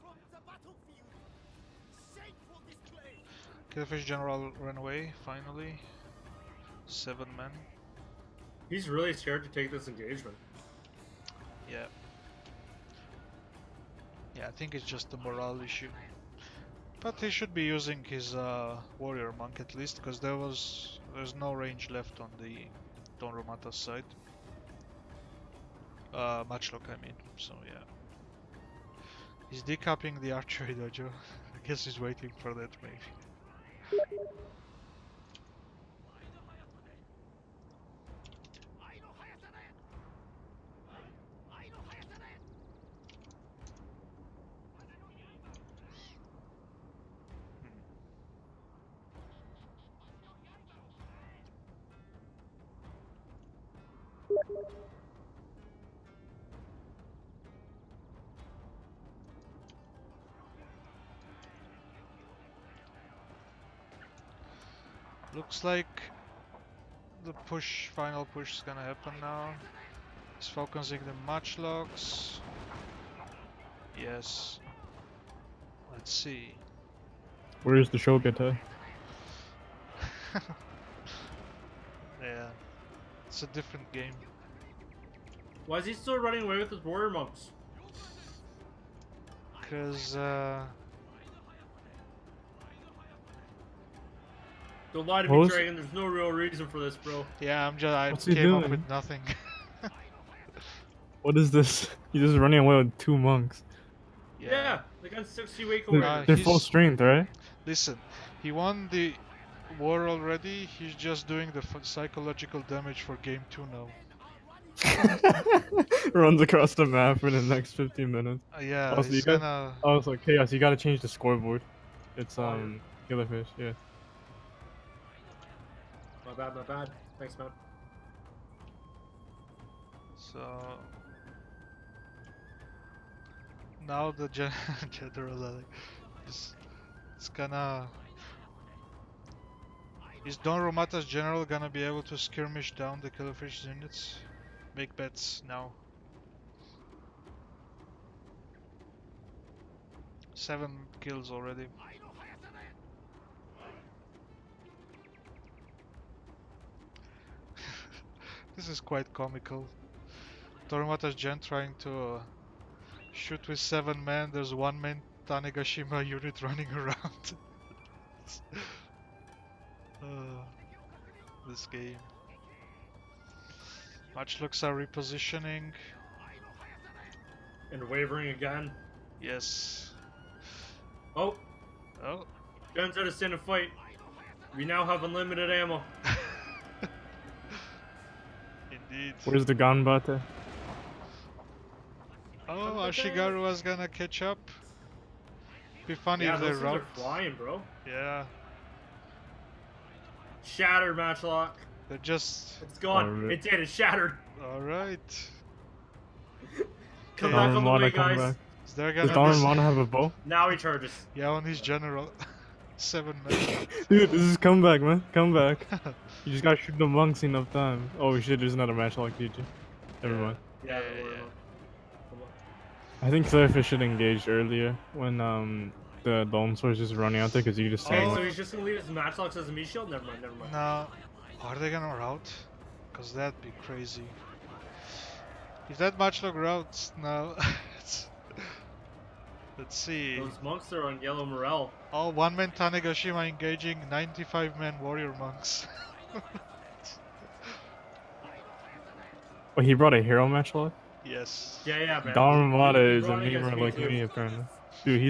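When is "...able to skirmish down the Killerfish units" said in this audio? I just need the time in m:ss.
2:21.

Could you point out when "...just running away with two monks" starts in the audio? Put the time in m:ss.
1:42.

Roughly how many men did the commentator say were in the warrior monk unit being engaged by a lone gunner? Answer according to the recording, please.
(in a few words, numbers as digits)
95.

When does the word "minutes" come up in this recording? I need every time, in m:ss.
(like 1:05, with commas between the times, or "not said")
1:58, 3:33.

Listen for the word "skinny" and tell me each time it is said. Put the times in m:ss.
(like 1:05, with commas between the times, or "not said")
not said.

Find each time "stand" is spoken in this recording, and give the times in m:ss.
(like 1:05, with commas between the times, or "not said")
3:03, 3:47.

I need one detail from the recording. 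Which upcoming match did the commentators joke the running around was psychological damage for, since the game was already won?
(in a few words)
game two.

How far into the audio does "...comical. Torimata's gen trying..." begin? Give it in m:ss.
2:39.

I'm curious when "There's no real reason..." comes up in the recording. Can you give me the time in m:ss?
1:35.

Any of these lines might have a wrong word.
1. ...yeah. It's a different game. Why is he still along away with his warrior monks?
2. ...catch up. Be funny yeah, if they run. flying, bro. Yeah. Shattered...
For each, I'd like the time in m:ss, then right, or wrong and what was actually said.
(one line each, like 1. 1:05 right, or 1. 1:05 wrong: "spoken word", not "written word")
1. 1:22 wrong: "running", not "along"
2. 3:13 right.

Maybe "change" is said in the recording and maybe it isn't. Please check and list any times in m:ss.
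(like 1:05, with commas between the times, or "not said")
2:00.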